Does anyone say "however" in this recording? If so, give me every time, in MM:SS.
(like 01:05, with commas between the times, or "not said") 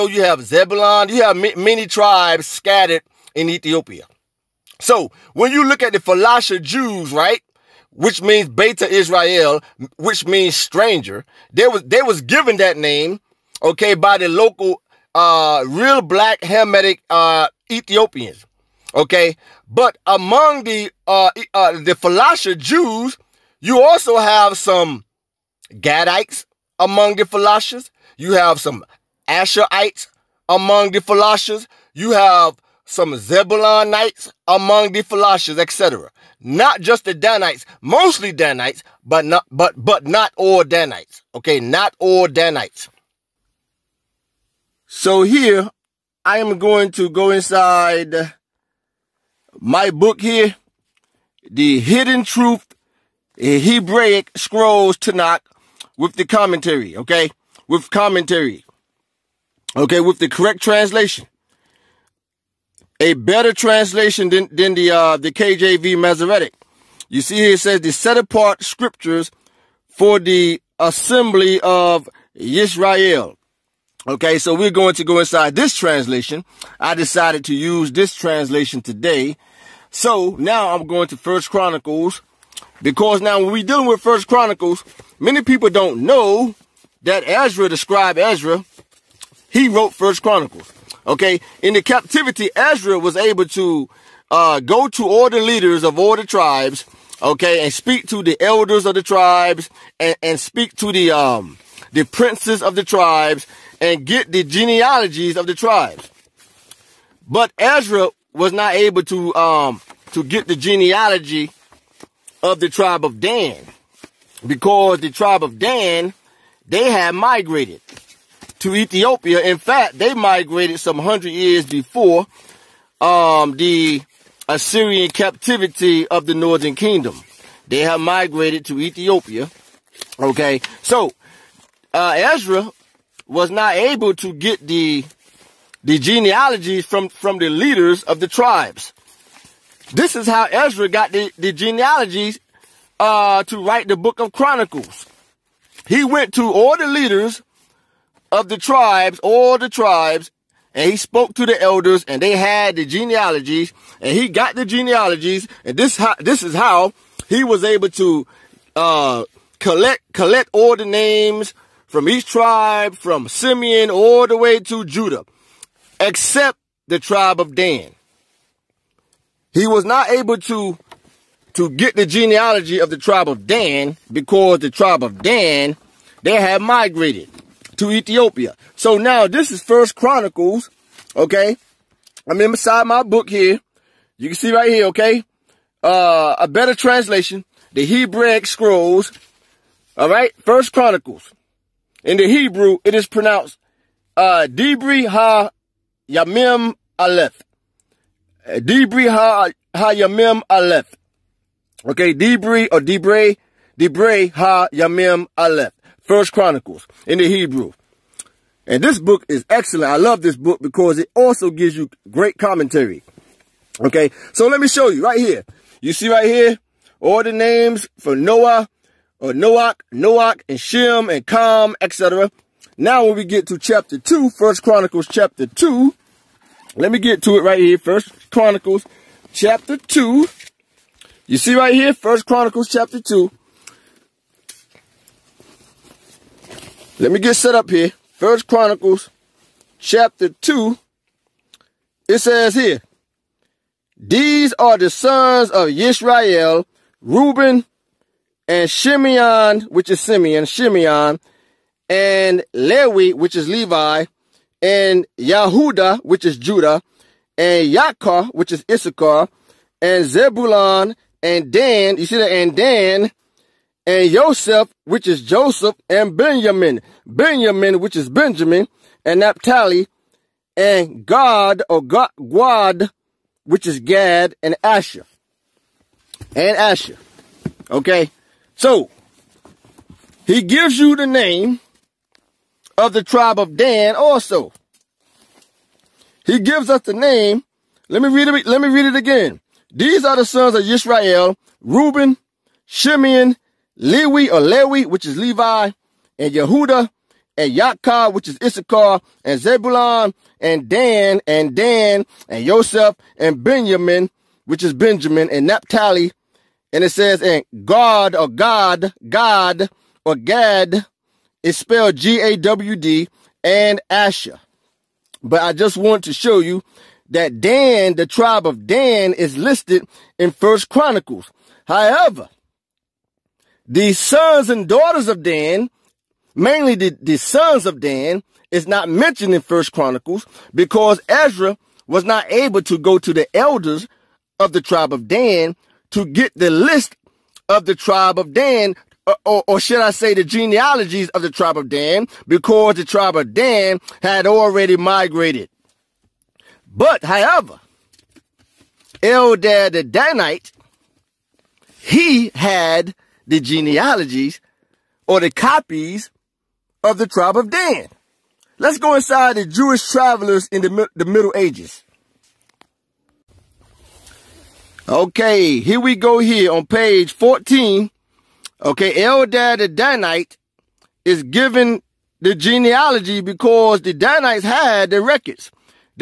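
05:21, 05:47.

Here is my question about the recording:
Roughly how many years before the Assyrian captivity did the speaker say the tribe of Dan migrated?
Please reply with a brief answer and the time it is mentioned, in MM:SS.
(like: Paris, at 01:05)
100, at 02:00.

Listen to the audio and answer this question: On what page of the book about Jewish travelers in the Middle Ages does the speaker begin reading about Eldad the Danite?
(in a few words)
14.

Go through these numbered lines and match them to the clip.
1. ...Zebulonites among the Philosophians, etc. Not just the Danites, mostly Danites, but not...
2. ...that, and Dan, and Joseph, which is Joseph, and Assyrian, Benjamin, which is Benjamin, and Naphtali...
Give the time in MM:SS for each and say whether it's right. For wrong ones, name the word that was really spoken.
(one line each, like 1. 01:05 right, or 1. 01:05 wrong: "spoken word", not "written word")
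1. 00:33 right
2. 04:22 wrong: "Benjamin", not "Assyrian".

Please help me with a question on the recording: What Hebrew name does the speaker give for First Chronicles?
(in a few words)
Debri Ha Yamim Aleph.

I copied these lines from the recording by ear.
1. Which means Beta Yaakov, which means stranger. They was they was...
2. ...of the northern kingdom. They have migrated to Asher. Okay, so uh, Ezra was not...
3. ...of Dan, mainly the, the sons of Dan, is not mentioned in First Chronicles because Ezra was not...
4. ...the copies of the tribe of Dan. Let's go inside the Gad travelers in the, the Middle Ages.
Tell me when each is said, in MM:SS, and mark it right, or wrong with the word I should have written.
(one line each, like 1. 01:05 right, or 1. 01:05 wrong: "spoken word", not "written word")
1. 00:07 wrong: "Israel", not "Yaakov"
2. 02:06 wrong: "Ethiopia", not "Asher"
3. 05:25 right
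4. 05:55 wrong: "Jewish", not "Gad".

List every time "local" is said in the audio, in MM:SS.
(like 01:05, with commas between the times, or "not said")
00:14.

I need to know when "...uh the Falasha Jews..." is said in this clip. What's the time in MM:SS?
00:21.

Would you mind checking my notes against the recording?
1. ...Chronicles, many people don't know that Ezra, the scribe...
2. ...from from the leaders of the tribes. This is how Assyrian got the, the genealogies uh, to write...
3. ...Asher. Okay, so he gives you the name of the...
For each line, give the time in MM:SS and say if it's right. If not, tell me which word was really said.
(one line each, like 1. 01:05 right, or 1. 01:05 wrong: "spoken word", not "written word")
1. 01:24 right
2. 02:16 wrong: "Ezra", not "Assyrian"
3. 04:36 right.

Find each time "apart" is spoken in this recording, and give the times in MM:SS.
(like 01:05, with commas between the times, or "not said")
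01:08.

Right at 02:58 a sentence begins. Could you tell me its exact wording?
So now this is First Chronicles, okay?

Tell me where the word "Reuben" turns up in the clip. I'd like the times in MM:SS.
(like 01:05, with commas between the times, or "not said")
04:07, 04:51.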